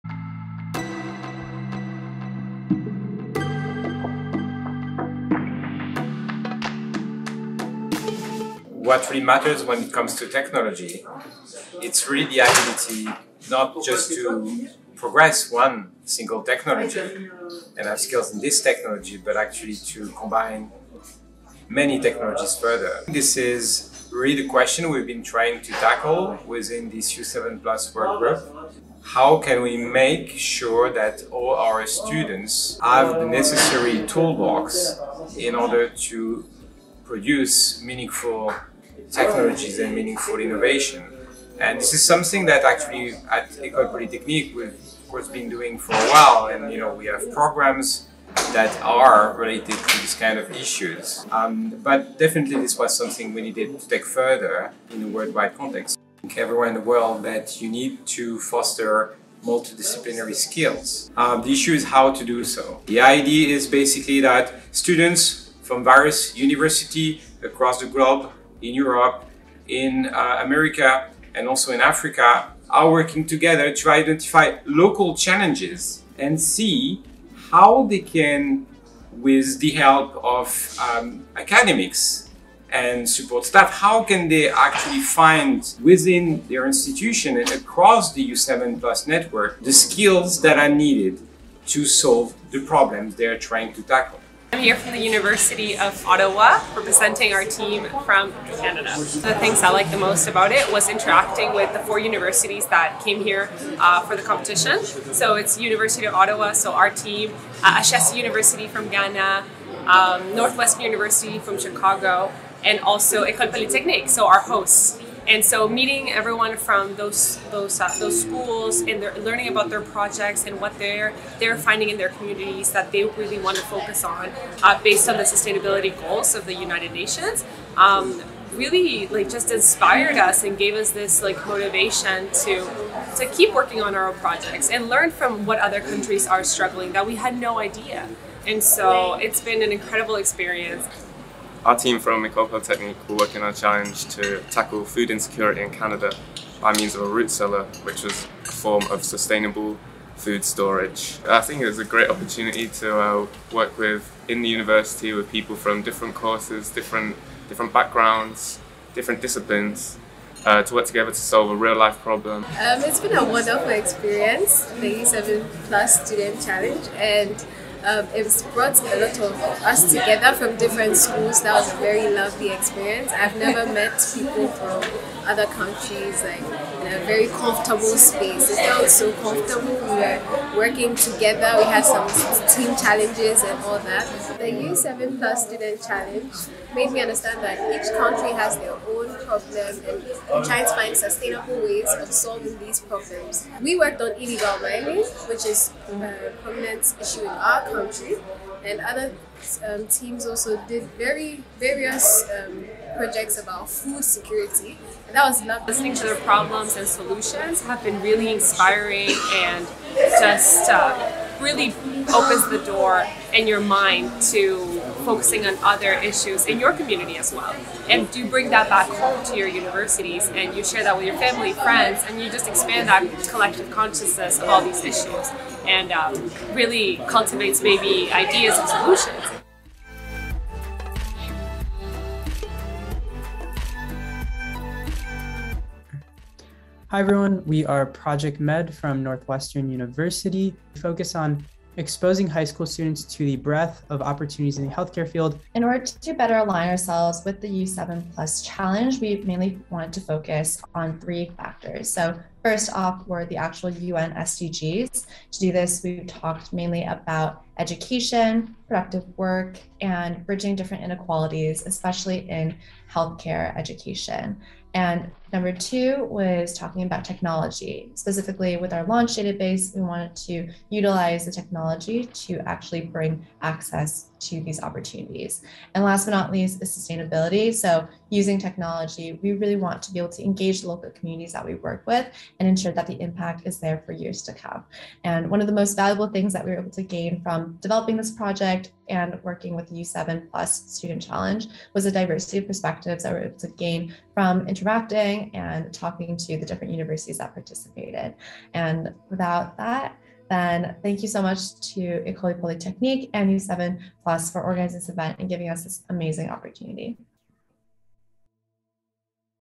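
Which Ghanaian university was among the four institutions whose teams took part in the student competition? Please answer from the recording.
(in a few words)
Ashesi University.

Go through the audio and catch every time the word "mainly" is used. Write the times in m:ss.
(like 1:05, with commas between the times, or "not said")
4:09, 4:16.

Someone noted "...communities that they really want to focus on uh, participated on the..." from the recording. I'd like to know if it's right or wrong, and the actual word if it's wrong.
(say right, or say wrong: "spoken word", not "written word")
wrong: "based", not "participated".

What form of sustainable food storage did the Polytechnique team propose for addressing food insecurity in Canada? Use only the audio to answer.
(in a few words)
A root cellar.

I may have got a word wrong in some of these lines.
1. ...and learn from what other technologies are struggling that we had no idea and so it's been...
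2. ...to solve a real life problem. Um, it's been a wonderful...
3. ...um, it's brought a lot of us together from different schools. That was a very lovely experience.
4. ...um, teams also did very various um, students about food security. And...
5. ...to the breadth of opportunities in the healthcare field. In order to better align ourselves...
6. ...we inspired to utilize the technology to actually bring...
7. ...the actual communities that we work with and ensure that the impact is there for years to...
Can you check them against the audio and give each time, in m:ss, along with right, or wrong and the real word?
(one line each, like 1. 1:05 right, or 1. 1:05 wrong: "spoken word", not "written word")
1. 2:14 wrong: "countries", not "technologies"
2. 2:41 right
3. 2:47 right
4. 3:19 wrong: "projects", not "students"
5. 4:03 right
6. 4:29 wrong: "wanted", not "inspired"
7. 4:40 wrong: "local", not "actual".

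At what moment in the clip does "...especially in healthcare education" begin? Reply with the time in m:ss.
4:21.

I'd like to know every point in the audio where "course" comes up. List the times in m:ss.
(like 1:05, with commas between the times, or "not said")
0:45, 2:36.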